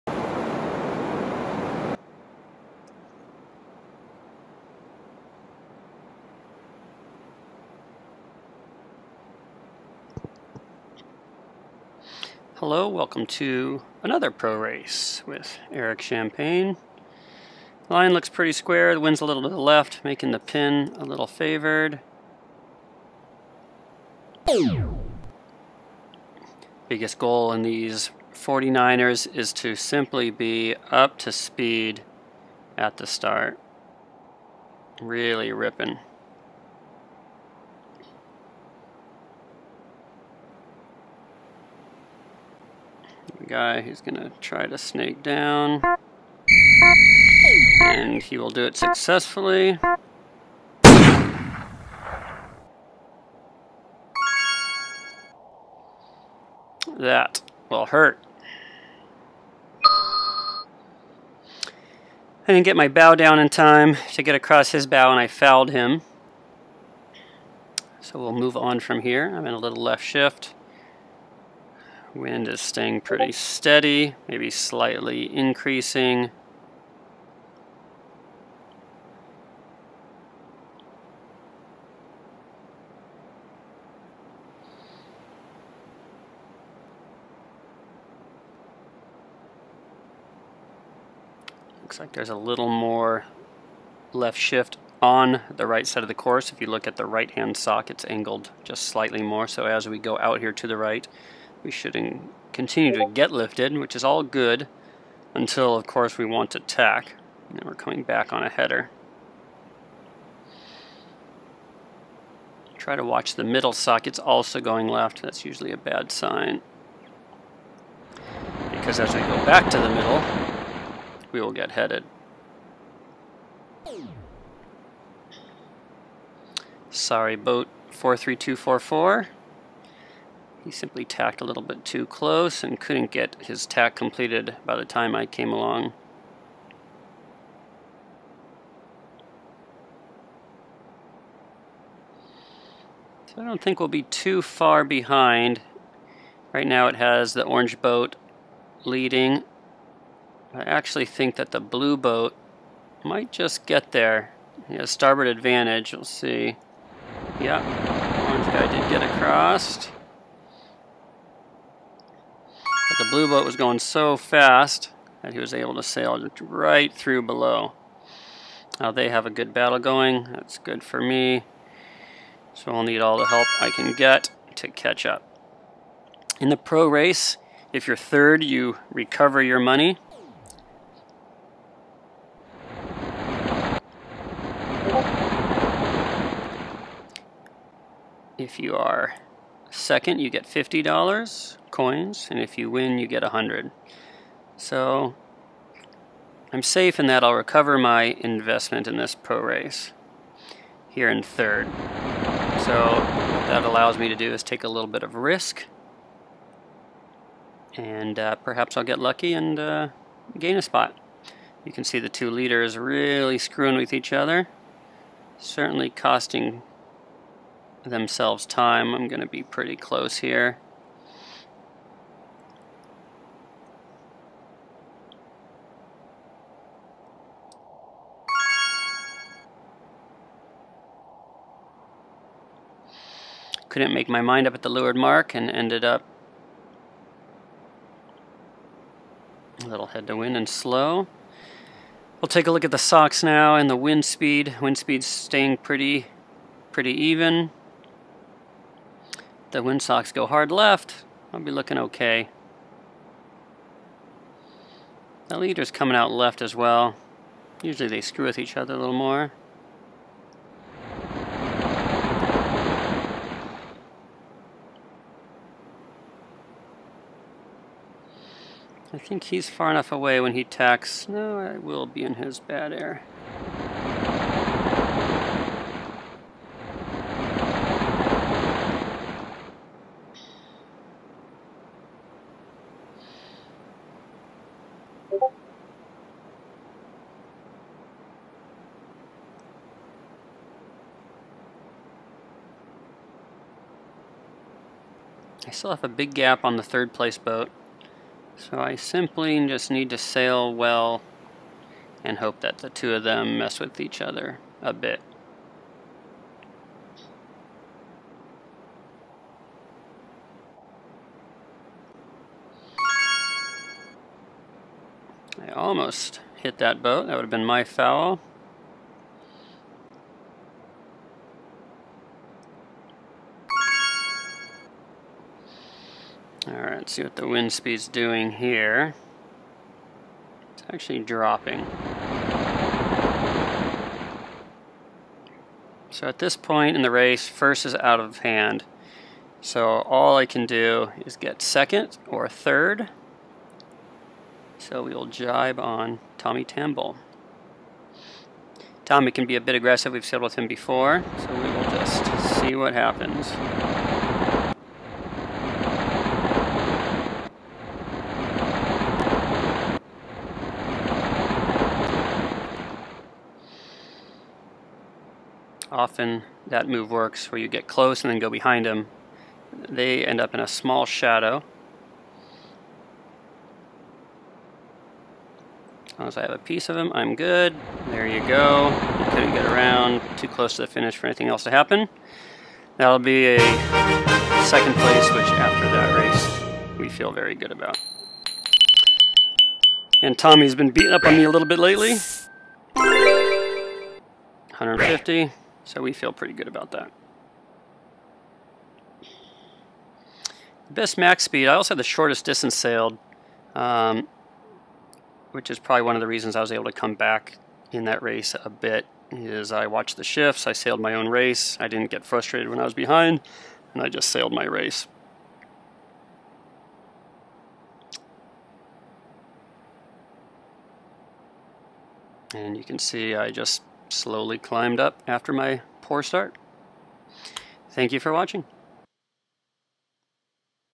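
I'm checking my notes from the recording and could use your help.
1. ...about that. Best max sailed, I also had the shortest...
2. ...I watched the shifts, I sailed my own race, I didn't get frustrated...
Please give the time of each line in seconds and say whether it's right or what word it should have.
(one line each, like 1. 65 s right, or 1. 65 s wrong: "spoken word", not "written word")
1. 396 s wrong: "speed", not "sailed"
2. 409 s right.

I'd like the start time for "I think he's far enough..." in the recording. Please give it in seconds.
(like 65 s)
268 s.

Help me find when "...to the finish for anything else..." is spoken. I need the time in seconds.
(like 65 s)
380 s.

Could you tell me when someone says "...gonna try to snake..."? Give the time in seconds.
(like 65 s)
44 s.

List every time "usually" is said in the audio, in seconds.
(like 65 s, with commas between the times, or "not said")
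115 s, 257 s.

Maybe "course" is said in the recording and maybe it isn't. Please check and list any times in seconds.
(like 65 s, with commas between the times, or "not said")
96 s, 105 s.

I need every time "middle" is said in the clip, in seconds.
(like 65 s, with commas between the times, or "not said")
113 s, 119 s.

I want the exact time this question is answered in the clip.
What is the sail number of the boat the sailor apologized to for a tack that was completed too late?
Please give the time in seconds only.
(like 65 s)
127 s.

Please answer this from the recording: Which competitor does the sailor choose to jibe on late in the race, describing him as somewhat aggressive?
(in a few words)
Tommy Tambell.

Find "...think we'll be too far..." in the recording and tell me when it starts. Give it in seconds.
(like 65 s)
143 s.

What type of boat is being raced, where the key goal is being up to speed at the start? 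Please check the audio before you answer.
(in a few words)
49ers.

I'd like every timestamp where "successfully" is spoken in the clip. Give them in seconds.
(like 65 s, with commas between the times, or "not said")
48 s.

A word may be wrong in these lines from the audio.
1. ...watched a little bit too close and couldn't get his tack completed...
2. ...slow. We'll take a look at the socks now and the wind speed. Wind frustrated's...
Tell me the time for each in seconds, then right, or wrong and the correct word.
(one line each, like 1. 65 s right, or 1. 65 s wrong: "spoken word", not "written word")
1. 131 s wrong: "tacked", not "watched"
2. 240 s wrong: "speed", not "frustrated".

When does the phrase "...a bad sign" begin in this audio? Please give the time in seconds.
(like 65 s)
115 s.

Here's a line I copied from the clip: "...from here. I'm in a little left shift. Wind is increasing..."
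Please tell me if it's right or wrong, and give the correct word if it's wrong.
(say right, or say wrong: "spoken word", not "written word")
wrong: "staying", not "increasing".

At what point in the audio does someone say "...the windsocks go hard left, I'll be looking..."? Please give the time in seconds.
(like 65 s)
249 s.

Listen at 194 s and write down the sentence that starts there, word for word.
So I'm safe in that I'll recover my investment in this pro race here in third.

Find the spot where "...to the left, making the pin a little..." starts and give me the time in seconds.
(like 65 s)
19 s.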